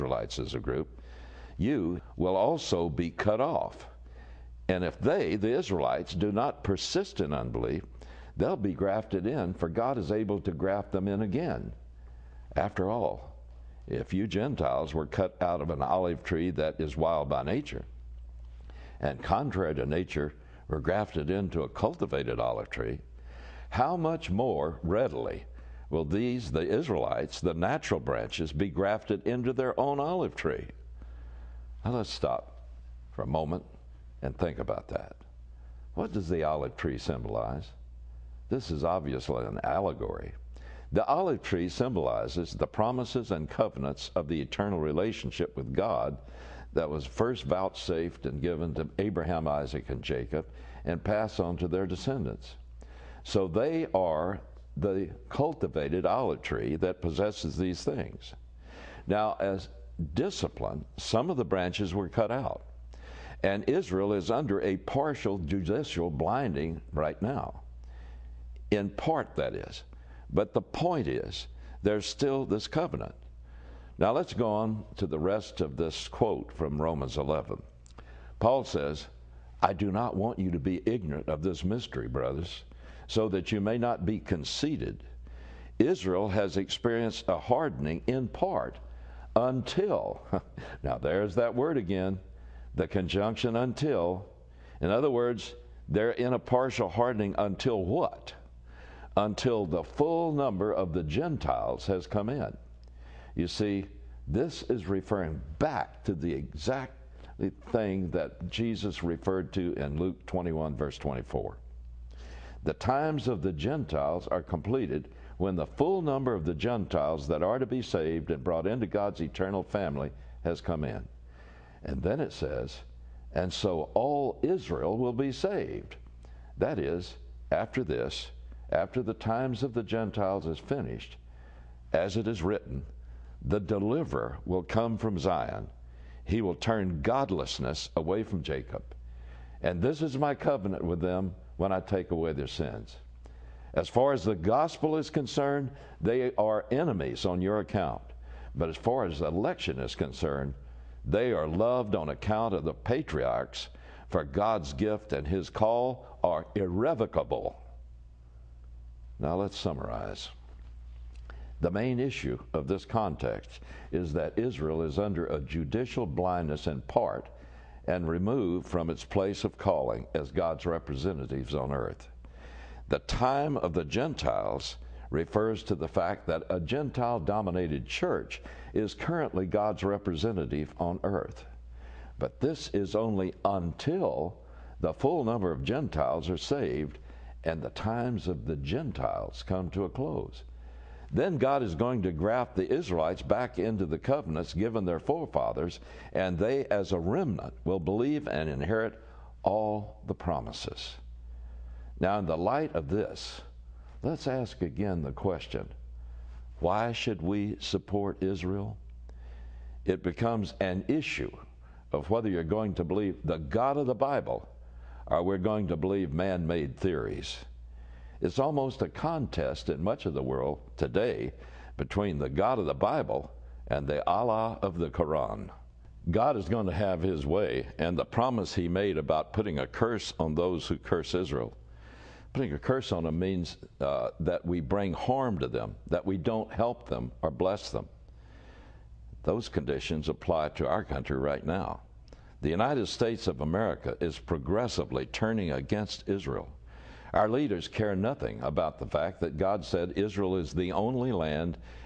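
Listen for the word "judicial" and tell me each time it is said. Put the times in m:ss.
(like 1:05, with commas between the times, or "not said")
1:05, 2:45.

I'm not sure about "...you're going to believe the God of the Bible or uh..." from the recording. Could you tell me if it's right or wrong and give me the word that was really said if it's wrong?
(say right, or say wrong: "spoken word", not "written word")
right.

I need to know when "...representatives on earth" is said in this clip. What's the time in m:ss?
2:50.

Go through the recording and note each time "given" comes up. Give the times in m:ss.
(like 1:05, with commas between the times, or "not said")
0:48, 3:14.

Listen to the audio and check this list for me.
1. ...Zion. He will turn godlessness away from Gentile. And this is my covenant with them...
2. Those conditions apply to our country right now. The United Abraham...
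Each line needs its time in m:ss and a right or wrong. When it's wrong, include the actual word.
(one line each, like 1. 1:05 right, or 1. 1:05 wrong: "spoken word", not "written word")
1. 2:15 wrong: "Jacob", not "Gentile"
2. 3:59 wrong: "States", not "Abraham".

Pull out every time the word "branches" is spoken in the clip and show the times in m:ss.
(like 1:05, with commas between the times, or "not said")
0:27, 1:01.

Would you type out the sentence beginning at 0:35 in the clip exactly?
What does the olive tree symbolize?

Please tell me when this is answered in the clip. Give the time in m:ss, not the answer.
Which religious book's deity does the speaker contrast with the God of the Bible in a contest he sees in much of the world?
3:44.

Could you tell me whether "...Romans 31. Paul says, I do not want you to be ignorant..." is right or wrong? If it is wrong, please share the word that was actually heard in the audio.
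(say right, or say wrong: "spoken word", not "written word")
wrong: "11", not "31".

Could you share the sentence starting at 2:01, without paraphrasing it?
And then it says, and so all Israel will be saved.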